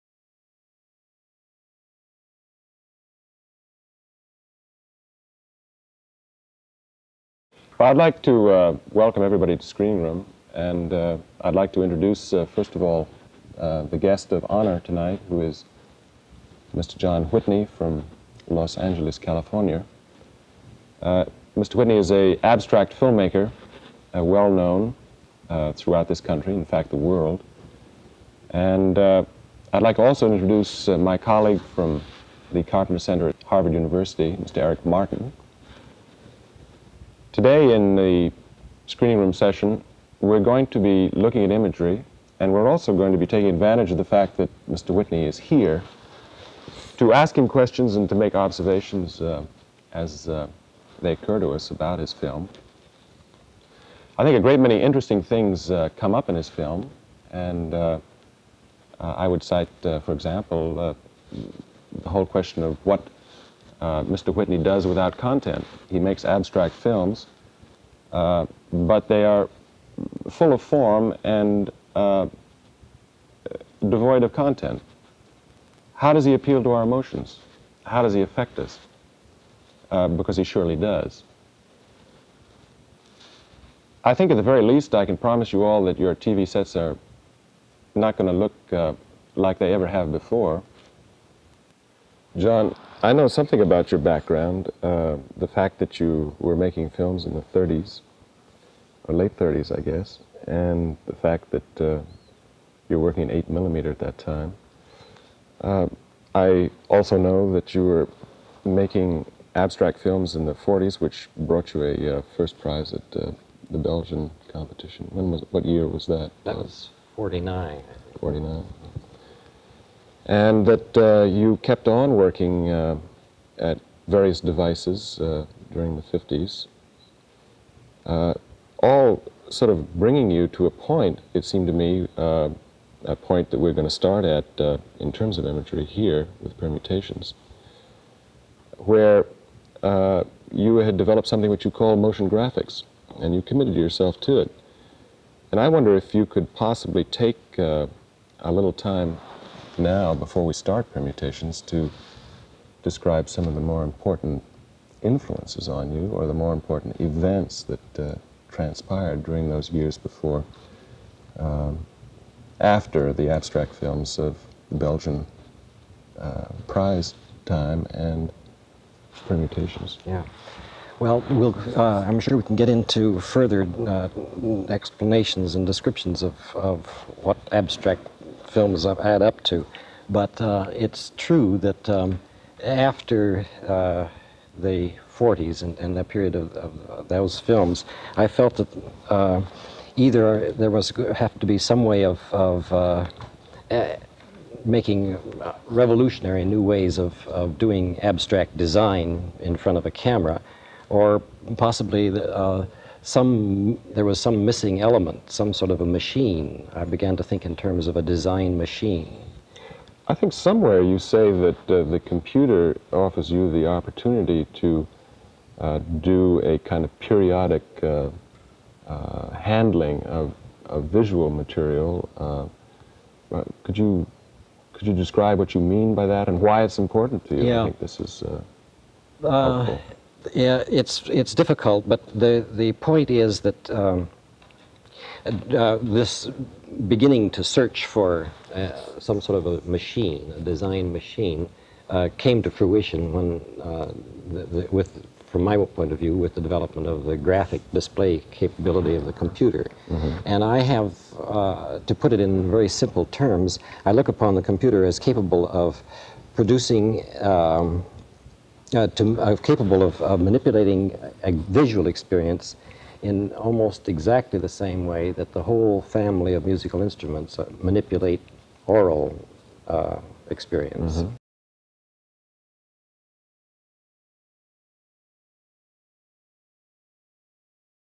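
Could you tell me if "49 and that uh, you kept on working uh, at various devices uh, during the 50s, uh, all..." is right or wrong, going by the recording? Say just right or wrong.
right.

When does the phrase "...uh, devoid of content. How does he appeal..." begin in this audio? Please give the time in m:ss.
1:11.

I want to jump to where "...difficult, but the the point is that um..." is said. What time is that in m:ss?
3:51.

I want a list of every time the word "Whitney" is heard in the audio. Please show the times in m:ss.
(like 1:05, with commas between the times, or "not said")
0:17, 0:21, 0:44, 1:04.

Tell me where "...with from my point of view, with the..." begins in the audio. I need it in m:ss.
4:04.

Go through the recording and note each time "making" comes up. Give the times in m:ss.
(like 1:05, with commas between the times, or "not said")
1:36, 1:48, 3:14.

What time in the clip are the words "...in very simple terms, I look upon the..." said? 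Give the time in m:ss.
4:12.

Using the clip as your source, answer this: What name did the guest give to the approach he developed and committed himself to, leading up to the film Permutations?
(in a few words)
motion graphics.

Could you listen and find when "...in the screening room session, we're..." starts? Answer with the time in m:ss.
0:37.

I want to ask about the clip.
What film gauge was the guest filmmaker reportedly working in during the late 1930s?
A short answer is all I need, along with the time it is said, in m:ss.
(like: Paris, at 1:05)
8 millimeter, at 1:43.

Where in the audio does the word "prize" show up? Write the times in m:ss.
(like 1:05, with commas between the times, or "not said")
1:52, 2:46.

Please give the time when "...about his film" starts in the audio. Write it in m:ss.
0:51.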